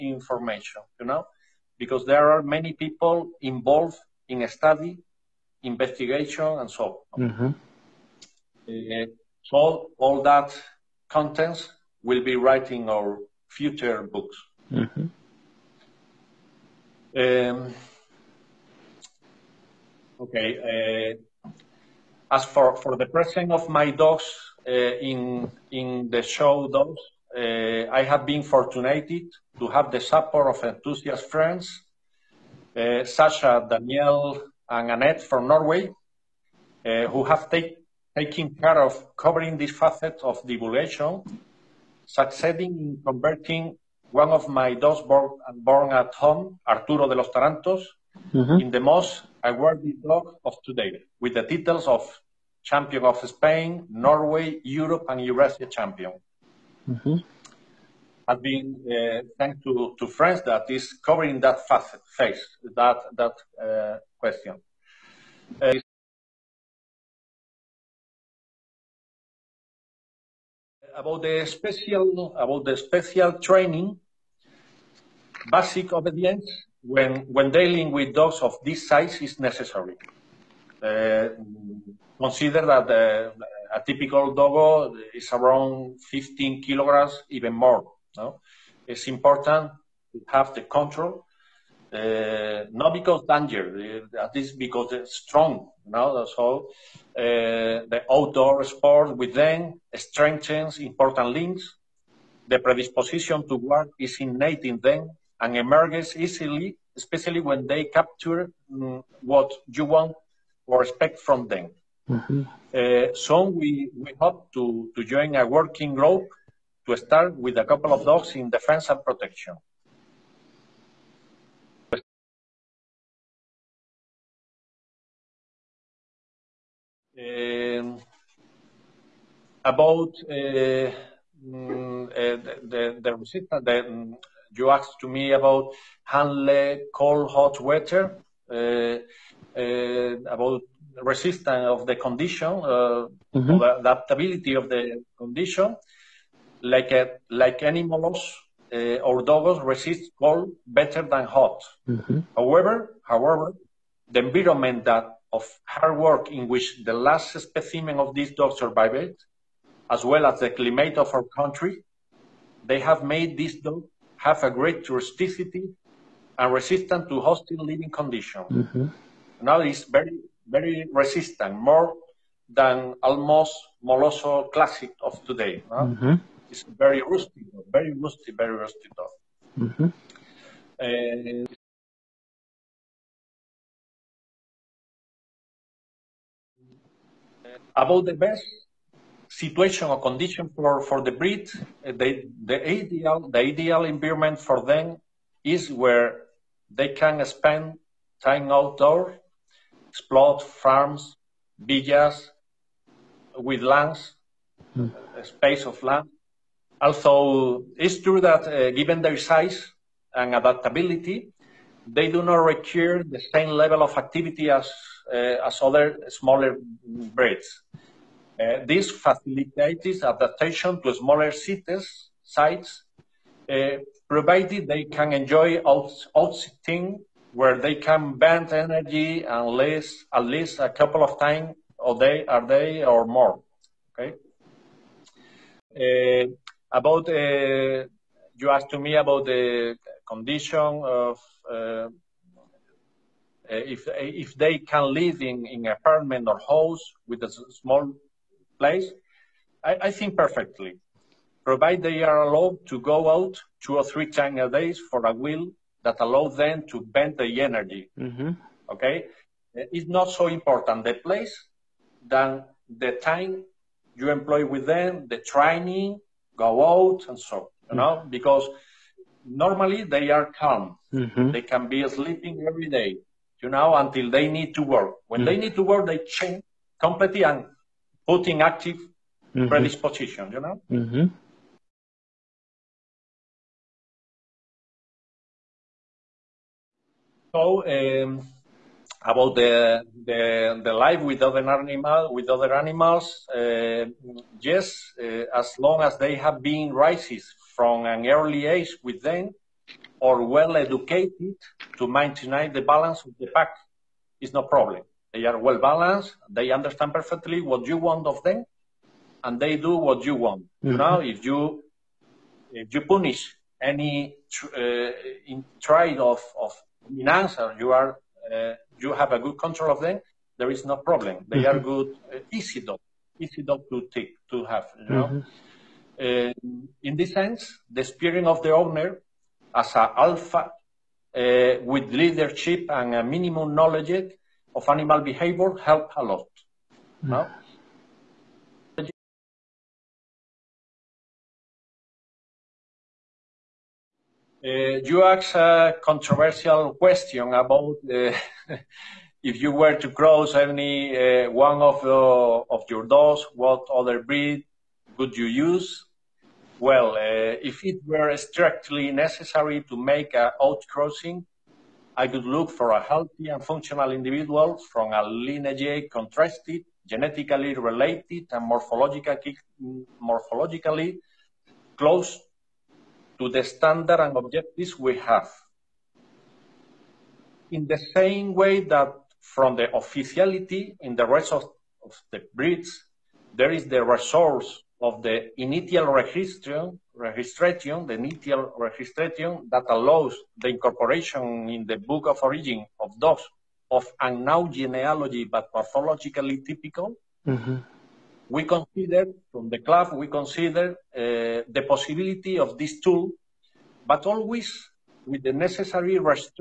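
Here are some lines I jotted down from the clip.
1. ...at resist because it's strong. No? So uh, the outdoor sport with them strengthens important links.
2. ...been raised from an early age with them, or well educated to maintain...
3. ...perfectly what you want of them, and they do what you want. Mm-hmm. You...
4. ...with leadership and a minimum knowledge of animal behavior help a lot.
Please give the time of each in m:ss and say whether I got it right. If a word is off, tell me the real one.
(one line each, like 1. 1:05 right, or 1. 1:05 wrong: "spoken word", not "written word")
1. 1:34 wrong: "least", not "resist"
2. 4:56 right
3. 5:06 right
4. 5:31 right.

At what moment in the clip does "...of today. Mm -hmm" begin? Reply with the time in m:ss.
2:55.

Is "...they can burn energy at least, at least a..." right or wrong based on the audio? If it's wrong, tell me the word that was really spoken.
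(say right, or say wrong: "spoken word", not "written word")
right.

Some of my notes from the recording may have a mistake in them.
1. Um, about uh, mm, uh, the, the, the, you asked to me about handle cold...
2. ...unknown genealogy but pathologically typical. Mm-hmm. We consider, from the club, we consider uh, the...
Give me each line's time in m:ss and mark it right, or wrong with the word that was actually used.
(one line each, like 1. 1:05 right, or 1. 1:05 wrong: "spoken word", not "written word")
1. 2:07 right
2. 6:34 right.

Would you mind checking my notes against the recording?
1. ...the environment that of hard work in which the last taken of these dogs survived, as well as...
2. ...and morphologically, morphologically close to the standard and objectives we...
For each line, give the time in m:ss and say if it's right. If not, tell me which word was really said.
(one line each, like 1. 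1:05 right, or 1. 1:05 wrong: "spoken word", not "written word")
1. 2:34 wrong: "specimen", not "taken"
2. 6:08 right.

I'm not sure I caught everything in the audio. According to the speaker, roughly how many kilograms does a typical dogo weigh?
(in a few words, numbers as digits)
15.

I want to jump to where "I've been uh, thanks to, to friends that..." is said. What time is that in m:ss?
0:58.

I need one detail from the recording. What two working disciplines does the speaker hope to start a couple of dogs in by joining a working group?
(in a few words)
defense and protection.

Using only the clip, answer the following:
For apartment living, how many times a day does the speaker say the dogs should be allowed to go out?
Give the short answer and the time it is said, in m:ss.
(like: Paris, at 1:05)
two or three, at 4:13.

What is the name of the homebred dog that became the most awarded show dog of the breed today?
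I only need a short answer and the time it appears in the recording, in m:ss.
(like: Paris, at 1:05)
Arturo de los Tarantos, at 0:46.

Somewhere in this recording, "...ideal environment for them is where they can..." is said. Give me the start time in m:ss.
3:13.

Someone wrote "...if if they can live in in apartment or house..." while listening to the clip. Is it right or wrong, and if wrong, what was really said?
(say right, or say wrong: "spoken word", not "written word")
right.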